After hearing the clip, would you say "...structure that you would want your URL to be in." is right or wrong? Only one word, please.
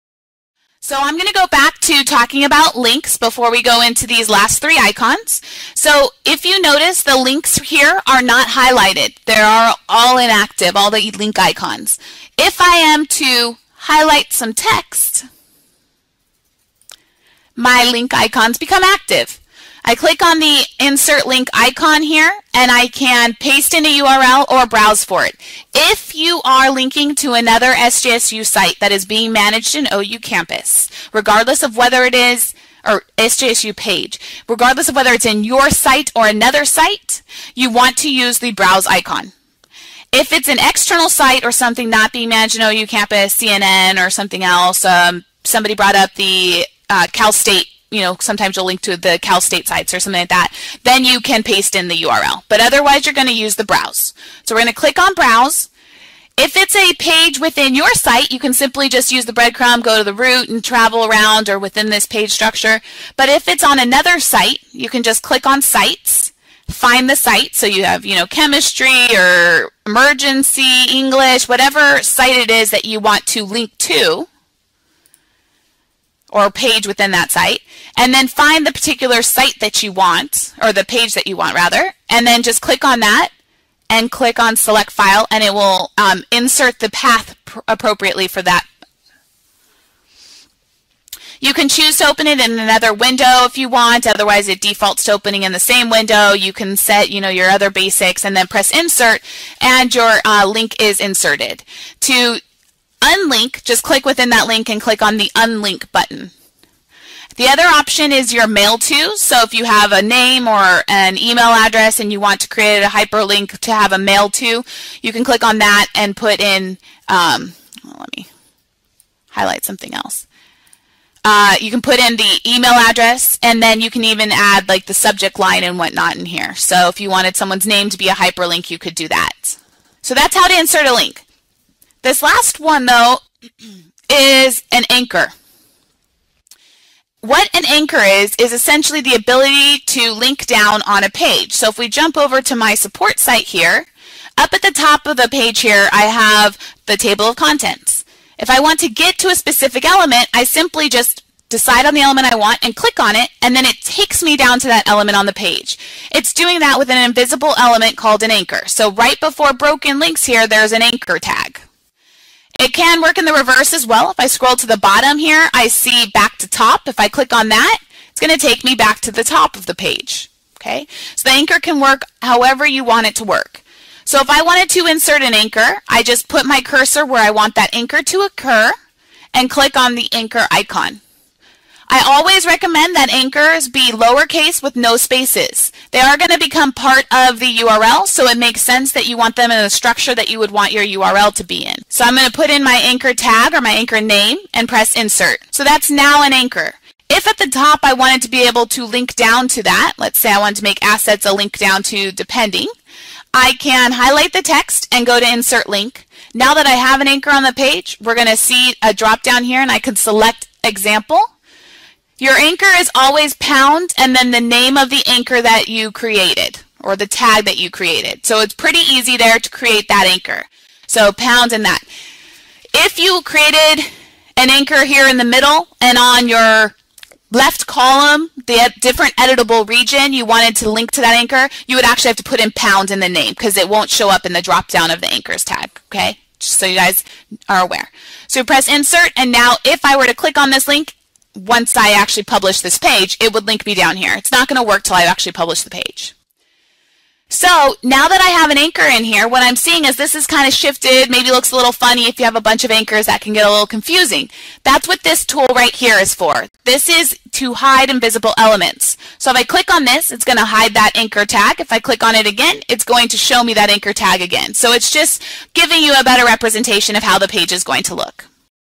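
right.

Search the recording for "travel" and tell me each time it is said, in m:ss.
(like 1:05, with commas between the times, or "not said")
1:00.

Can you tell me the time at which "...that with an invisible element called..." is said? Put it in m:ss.
2:36.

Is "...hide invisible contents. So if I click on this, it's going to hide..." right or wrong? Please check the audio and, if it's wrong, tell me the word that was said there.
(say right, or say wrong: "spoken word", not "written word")
wrong: "elements", not "contents".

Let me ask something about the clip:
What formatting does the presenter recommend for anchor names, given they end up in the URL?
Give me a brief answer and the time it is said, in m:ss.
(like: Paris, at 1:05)
lowercase with no spaces, at 3:03.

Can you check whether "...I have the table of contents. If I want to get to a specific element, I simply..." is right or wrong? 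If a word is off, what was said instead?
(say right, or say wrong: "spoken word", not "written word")
right.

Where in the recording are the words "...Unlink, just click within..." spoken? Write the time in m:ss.
1:43.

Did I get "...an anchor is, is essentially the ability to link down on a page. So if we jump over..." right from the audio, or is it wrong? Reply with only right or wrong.
right.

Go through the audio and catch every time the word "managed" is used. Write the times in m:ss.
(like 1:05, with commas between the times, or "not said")
0:29, 0:42.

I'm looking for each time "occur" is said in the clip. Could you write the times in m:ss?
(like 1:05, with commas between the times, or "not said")
2:58.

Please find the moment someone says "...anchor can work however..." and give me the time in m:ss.
2:51.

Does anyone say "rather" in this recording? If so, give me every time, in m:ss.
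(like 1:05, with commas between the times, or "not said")
1:21.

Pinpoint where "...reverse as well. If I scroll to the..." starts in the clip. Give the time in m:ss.
2:43.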